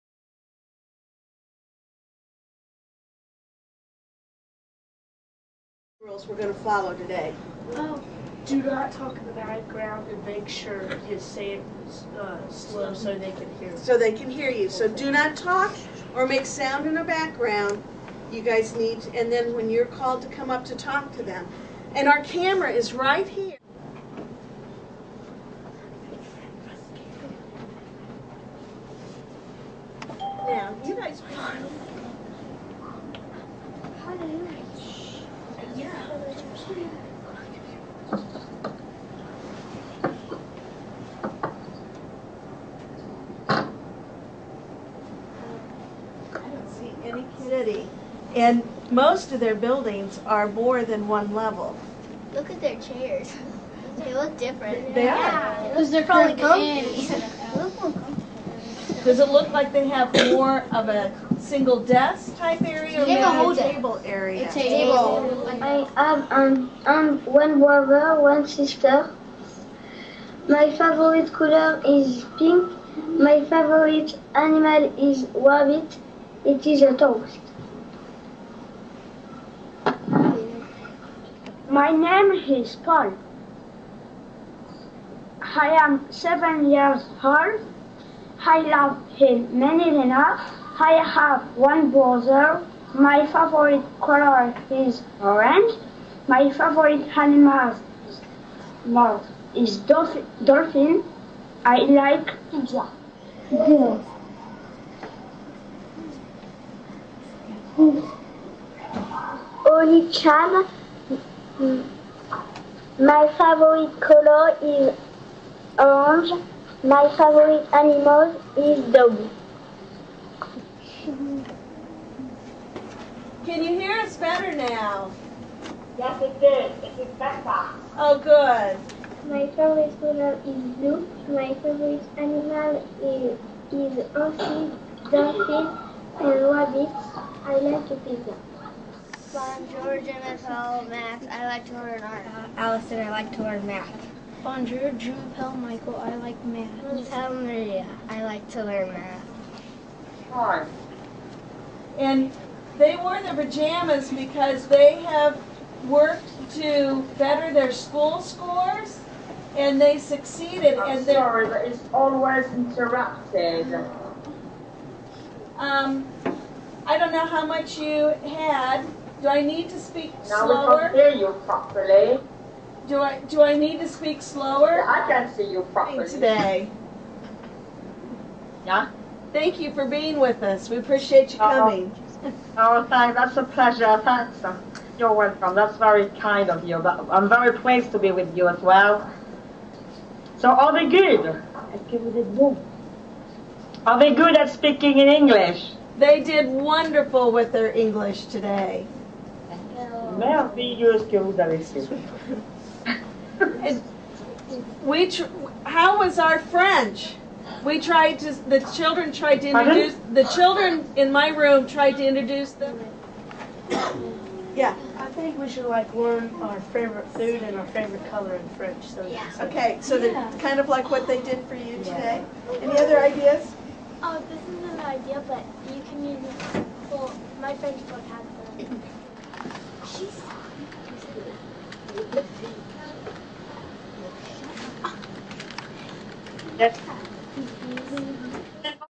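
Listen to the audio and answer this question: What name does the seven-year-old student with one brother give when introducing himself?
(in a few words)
Paul.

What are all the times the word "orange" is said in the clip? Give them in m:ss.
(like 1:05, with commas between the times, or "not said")
1:35, 1:55.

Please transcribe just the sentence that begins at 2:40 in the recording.
I'm and sorry, but it's always interrupted.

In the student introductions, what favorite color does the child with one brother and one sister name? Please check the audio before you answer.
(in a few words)
pink.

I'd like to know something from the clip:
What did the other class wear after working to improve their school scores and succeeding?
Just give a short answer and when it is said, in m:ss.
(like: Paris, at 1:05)
pajamas, at 2:33.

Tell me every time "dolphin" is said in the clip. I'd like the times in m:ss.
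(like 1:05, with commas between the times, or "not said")
1:40, 2:15.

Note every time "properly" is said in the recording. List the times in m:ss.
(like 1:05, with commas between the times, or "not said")
2:51, 2:55.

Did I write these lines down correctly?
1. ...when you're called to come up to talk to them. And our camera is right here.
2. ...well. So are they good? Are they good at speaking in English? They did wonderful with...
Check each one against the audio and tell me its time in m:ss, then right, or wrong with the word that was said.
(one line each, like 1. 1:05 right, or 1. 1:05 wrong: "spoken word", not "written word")
1. 0:19 right
2. 3:08 right.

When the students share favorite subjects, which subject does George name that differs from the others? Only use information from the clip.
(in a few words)
art.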